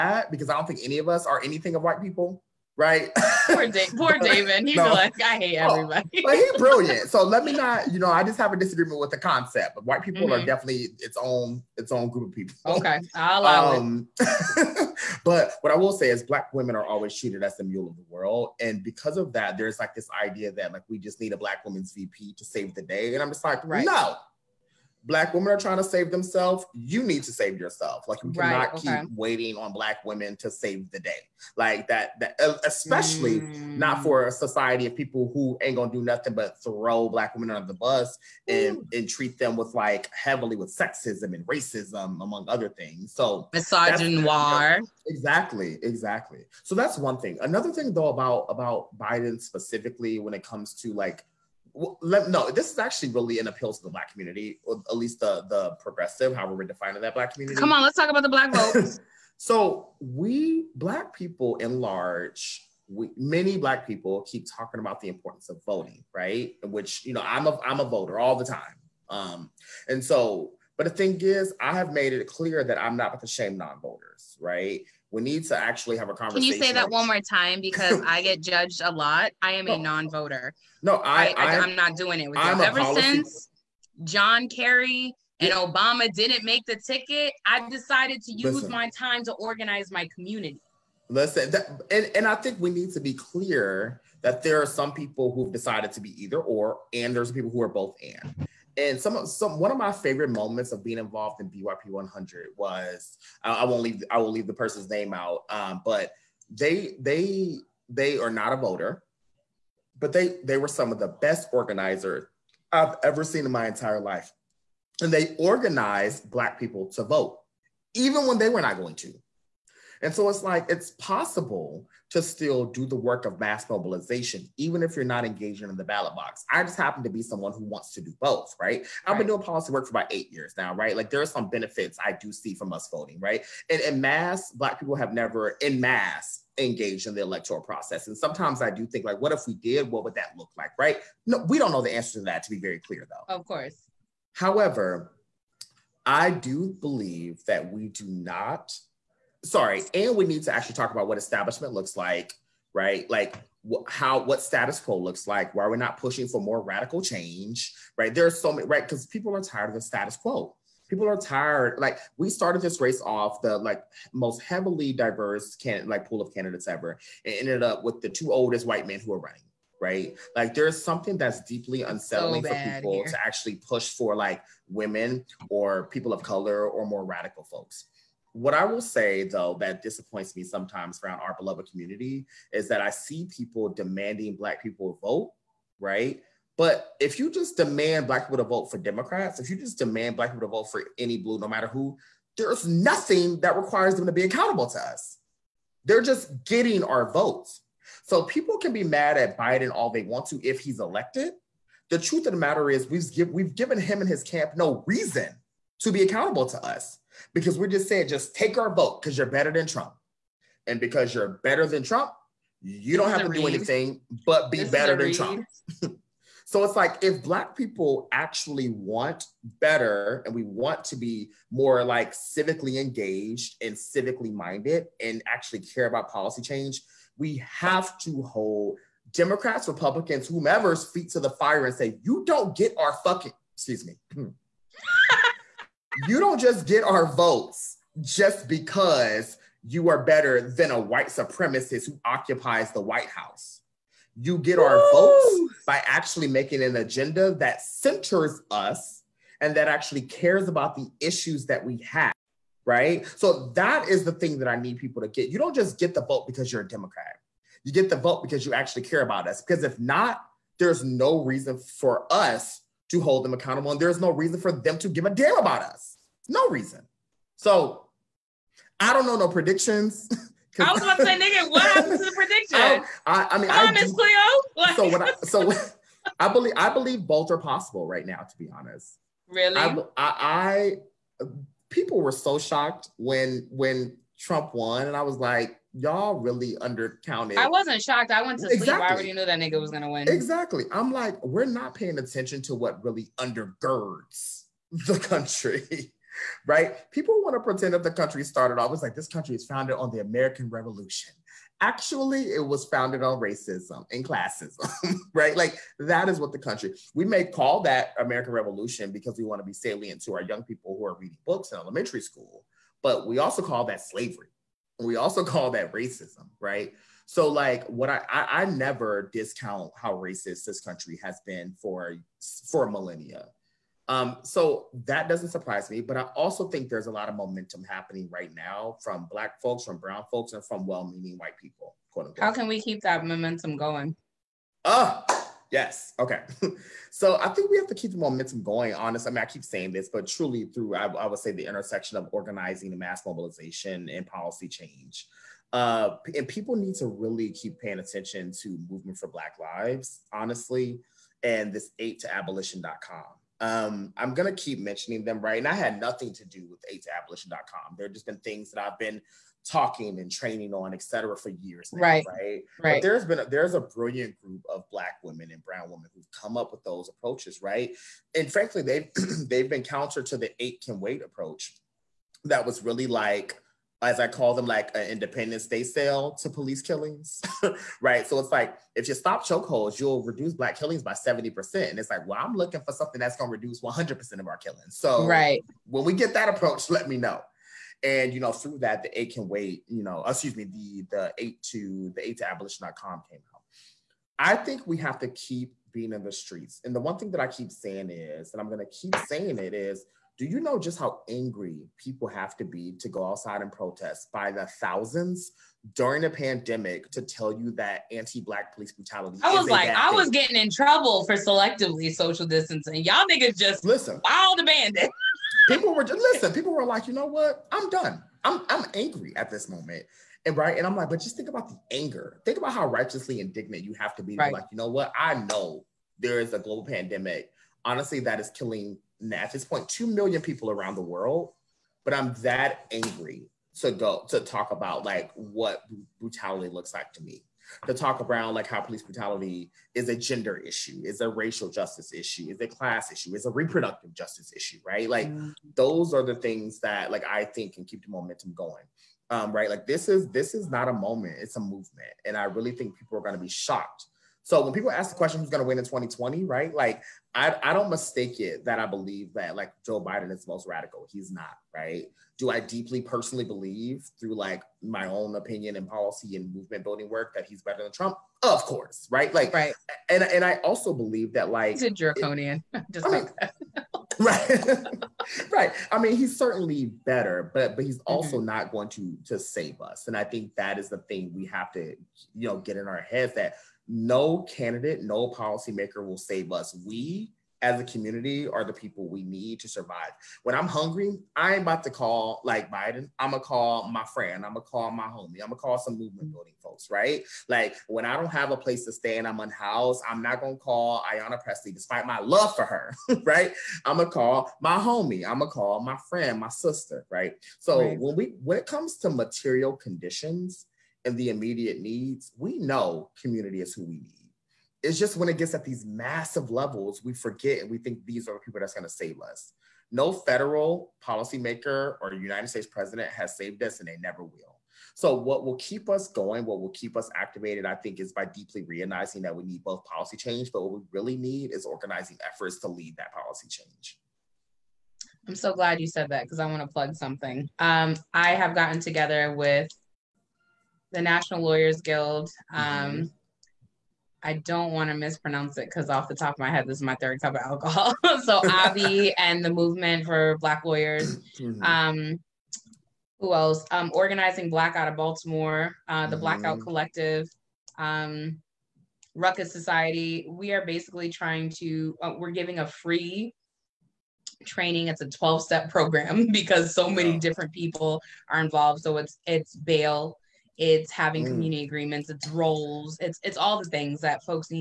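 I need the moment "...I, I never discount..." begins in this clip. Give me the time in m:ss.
5:18.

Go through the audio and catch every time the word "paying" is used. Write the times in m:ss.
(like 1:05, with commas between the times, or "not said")
4:51, 5:47.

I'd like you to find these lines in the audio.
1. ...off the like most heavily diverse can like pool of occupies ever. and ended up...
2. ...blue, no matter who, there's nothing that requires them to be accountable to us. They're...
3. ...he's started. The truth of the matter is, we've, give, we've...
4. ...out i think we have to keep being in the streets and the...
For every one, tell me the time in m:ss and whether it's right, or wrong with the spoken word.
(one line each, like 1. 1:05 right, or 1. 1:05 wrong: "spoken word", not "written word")
1. 2:43 wrong: "candidates", not "occupies"
2. 3:11 right
3. 3:20 wrong: "elected", not "started"
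4. 6:33 right.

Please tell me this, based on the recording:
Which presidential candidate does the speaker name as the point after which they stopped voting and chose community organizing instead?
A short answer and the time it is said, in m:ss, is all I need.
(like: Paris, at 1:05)
John Kerry, at 1:24.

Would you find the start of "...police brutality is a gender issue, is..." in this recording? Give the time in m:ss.
7:18.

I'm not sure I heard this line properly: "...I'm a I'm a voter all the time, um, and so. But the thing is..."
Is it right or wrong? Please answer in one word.
right.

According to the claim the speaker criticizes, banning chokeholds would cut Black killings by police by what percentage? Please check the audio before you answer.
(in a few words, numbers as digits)
70 percent.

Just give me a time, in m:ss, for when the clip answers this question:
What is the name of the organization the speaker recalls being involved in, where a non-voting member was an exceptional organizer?
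1:41.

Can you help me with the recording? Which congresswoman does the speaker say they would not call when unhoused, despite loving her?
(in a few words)
Ayanna Pressley.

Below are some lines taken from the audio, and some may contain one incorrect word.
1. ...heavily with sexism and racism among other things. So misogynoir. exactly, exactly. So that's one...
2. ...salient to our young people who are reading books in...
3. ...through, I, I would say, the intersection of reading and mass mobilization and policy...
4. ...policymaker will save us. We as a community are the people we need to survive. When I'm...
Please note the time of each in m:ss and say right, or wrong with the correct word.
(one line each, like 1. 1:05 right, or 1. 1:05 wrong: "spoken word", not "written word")
1. 0:40 right
2. 5:09 right
3. 5:40 wrong: "organizing", not "reading"
4. 8:05 right.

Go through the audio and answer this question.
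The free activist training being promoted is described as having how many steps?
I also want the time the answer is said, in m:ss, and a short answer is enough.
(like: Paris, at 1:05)
12, at 9:24.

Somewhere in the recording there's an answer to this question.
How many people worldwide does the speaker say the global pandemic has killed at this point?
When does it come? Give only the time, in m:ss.
7:09.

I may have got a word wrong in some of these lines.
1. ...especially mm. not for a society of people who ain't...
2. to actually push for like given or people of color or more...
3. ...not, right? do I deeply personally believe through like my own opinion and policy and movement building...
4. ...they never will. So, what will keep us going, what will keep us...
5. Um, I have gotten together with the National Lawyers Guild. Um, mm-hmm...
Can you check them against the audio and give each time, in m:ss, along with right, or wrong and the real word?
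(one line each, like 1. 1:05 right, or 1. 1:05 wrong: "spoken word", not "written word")
1. 0:32 right
2. 2:53 wrong: "women", not "given"
3. 7:41 right
4. 8:43 right
5. 8:57 right.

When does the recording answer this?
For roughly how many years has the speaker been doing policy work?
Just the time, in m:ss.
2:10.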